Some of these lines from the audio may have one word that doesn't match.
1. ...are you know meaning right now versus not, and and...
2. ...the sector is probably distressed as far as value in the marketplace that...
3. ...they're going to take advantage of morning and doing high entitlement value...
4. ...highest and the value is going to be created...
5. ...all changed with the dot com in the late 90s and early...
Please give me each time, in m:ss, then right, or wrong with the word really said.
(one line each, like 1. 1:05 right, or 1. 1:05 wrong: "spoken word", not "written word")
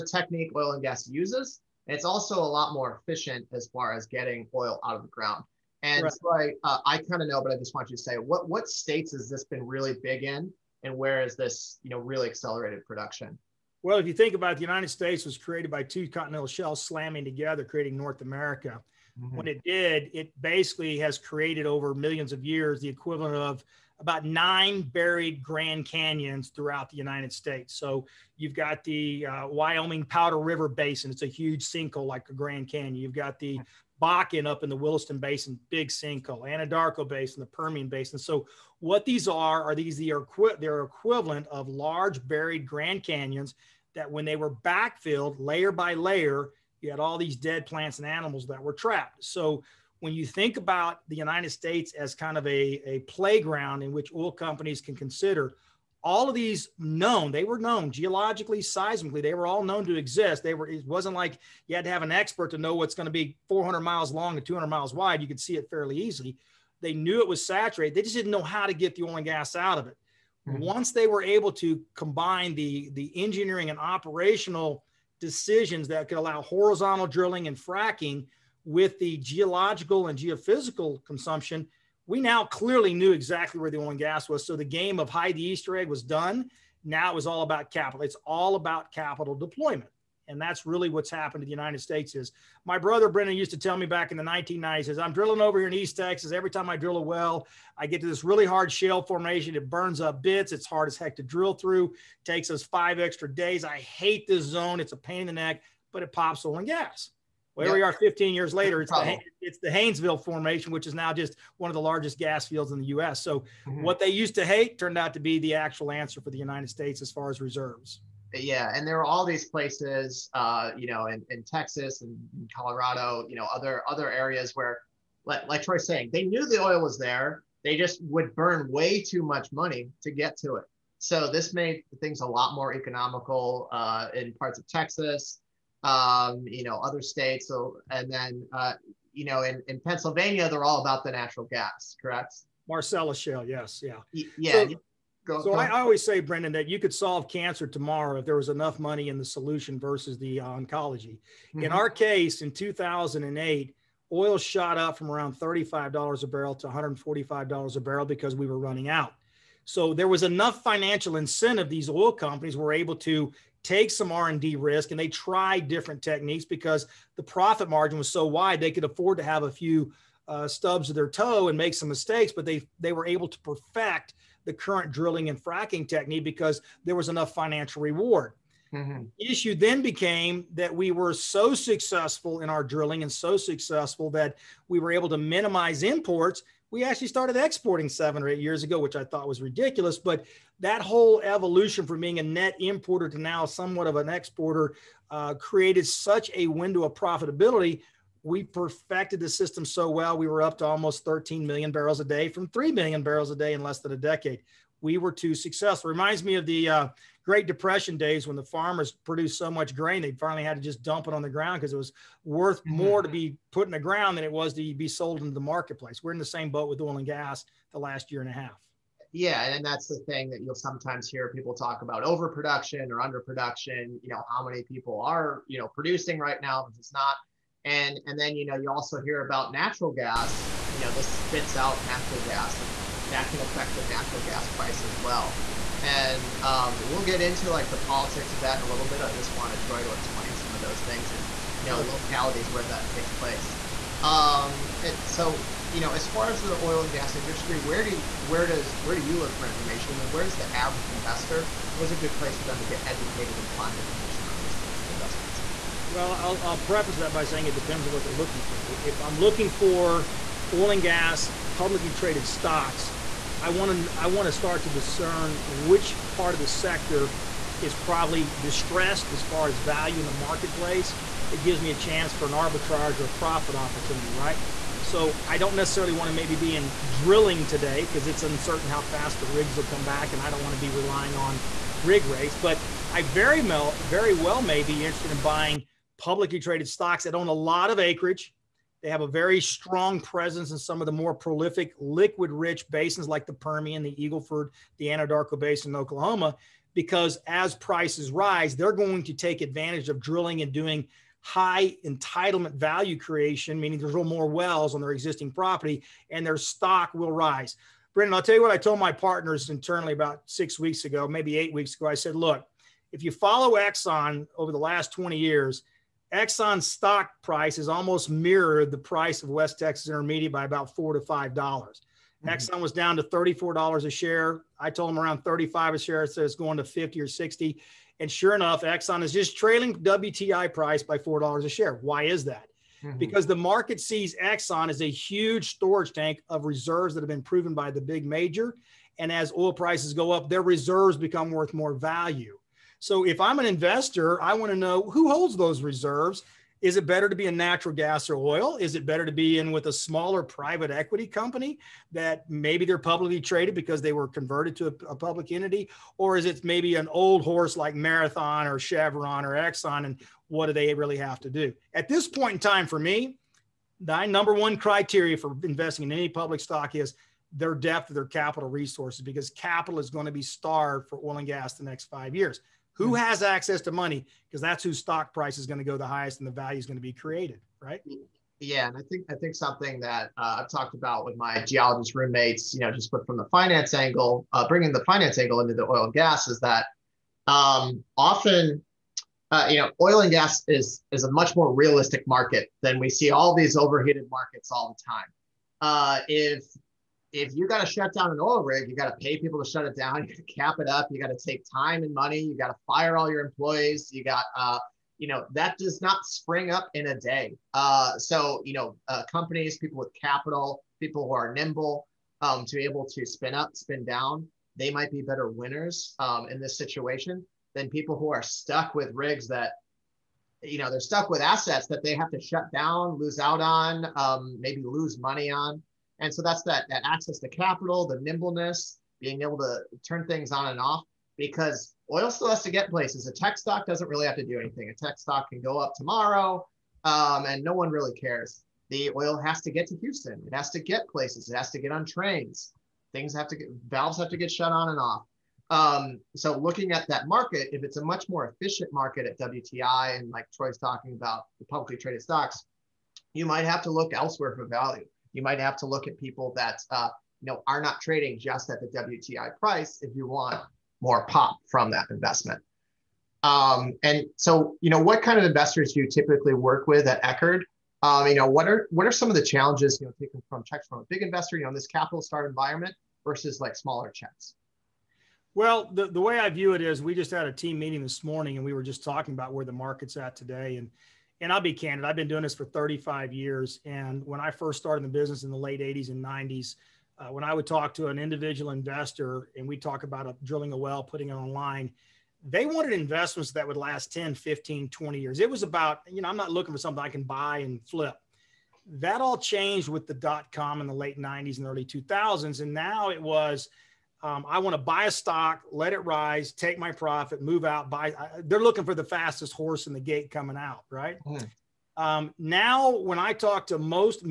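1. 3:45 wrong: "producing", not "meaning"
2. 4:26 right
3. 4:58 wrong: "drilling", not "morning"
4. 6:15 right
5. 8:19 right.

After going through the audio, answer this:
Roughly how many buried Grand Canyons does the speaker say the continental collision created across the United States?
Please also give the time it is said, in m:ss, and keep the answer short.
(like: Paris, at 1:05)
9, at 0:24.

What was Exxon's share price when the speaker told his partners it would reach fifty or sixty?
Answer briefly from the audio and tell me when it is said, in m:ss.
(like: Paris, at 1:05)
$34, at 5:23.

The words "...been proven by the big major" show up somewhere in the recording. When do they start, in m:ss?
5:37.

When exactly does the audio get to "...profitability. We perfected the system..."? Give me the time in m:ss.
3:16.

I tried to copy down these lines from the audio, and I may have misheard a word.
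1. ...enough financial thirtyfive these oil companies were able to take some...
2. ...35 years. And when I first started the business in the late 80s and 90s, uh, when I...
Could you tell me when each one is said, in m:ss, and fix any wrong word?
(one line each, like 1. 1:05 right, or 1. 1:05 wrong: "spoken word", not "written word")
1. 2:40 wrong: "incentive", not "thirtyfive"
2. 8:02 right.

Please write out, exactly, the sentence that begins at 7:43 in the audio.
Um, and so, you know, what kind of investors do you typically work with at Eckard?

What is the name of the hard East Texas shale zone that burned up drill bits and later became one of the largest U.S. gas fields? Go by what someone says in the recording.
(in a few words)
Haynesville formation.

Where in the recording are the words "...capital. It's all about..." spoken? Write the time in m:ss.
1:27.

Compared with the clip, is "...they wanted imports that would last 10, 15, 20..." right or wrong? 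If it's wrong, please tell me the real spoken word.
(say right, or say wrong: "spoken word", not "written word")
wrong: "investments", not "imports".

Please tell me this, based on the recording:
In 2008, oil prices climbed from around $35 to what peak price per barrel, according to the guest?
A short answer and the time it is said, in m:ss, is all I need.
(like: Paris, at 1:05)
$145, at 2:36.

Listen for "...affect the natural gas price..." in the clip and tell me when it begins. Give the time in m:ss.
3:53.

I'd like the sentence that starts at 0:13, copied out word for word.
Well, if you think about it, the United States was created by two continental shells slamming together, creating North America.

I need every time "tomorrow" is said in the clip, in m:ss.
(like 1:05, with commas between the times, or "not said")
2:27, 7:15.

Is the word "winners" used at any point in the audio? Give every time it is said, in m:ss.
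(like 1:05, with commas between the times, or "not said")
6:55.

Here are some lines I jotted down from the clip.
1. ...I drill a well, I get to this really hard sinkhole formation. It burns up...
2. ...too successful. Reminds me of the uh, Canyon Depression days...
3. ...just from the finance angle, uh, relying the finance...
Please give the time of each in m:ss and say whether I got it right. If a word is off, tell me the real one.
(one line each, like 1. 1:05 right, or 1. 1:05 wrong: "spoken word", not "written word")
1. 1:36 wrong: "shale", not "sinkhole"
2. 3:25 wrong: "Great", not "Canyon"
3. 6:22 wrong: "bringing", not "relying".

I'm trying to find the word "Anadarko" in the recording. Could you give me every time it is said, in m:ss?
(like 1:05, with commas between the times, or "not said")
0:36, 4:54.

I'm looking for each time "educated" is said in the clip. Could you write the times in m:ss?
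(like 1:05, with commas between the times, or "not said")
4:12.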